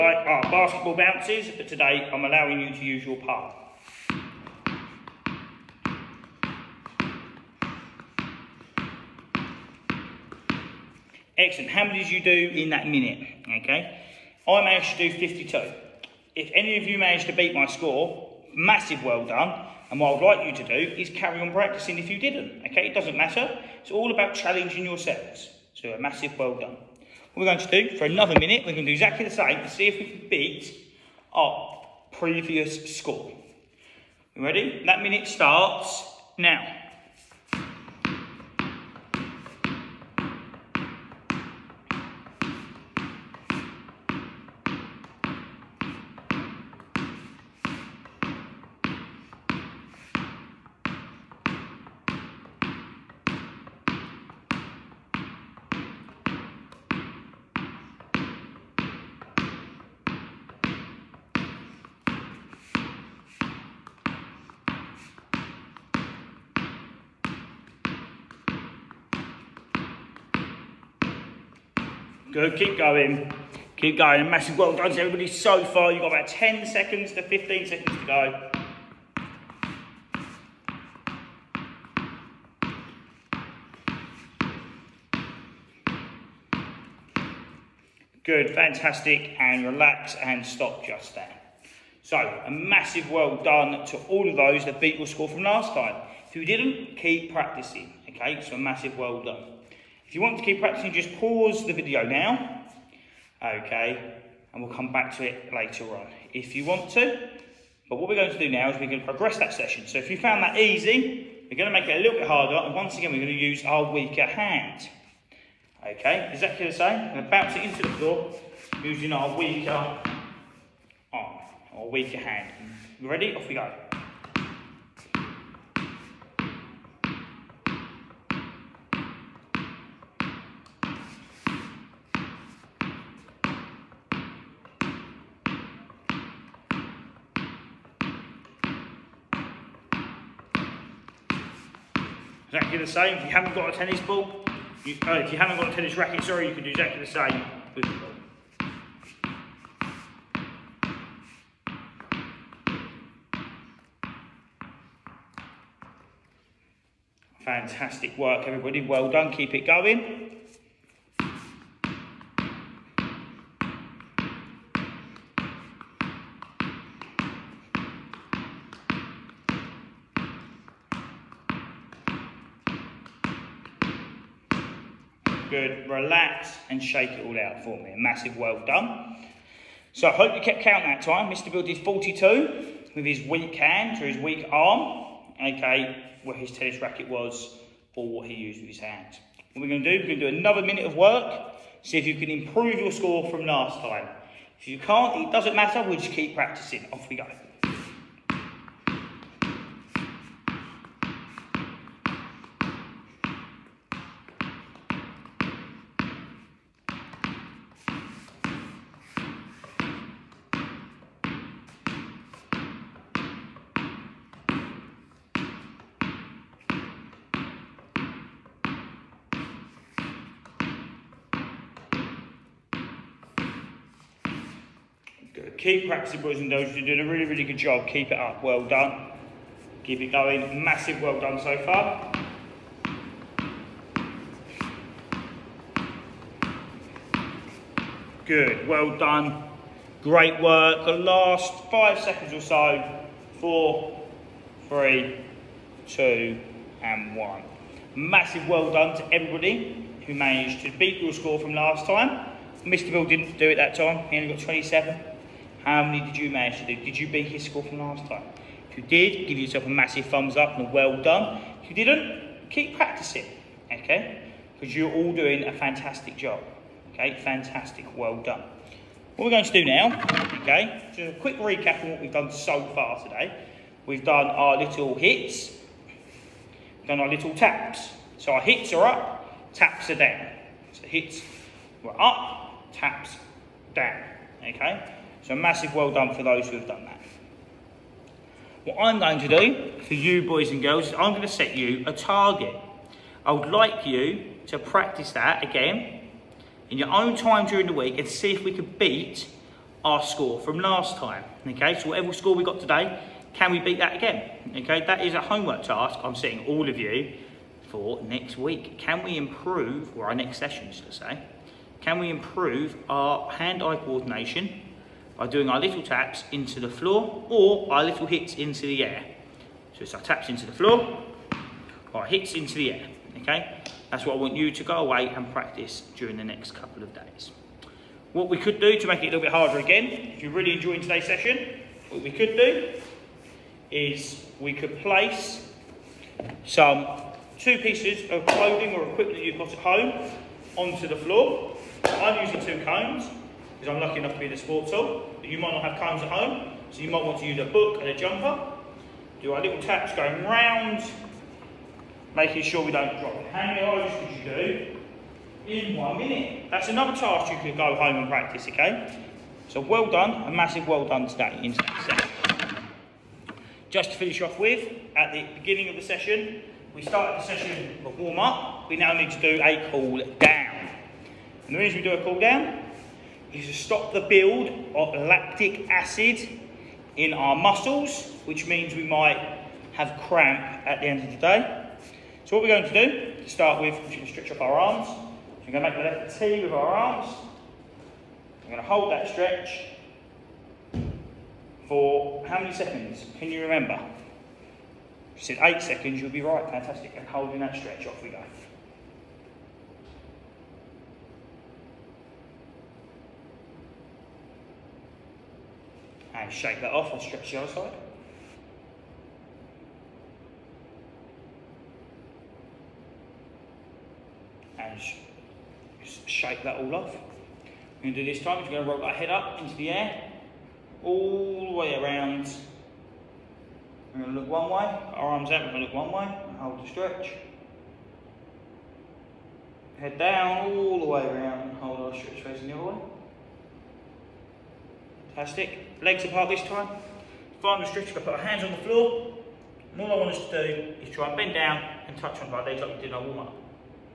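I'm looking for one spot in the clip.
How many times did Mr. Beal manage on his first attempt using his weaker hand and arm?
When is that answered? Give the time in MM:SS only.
03:01.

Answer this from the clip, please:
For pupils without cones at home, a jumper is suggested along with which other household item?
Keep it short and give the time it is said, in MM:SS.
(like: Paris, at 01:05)
a book, at 05:47.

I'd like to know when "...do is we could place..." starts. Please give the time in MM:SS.
05:32.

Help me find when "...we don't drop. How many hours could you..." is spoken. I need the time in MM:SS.
05:52.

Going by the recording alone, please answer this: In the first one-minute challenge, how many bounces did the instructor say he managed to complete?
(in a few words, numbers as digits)
52.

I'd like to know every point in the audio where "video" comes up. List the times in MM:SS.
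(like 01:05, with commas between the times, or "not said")
01:41.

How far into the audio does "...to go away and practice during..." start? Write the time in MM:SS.
05:24.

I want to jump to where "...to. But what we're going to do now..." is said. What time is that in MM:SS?
01:46.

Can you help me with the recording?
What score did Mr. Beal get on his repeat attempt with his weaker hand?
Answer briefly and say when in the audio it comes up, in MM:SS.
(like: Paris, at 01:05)
27, at 04:14.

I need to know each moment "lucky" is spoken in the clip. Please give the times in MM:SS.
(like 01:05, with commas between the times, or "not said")
05:43.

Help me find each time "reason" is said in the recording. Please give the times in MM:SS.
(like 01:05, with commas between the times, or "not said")
06:11.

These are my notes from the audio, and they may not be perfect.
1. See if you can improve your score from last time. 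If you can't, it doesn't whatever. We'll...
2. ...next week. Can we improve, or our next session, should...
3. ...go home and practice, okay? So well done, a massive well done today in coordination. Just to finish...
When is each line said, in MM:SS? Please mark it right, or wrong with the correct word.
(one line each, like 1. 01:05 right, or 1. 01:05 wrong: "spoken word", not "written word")
1. 03:11 wrong: "matter", not "whatever"
2. 05:08 right
3. 05:57 wrong: "session", not "coordination".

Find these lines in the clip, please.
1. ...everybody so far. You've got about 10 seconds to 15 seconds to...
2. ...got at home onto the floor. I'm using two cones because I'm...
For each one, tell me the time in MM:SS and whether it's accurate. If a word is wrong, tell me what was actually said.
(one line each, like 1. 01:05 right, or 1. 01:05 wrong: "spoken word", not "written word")
1. 01:15 right
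2. 05:39 right.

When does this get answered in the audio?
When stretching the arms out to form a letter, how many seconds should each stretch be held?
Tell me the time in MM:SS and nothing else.
06:35.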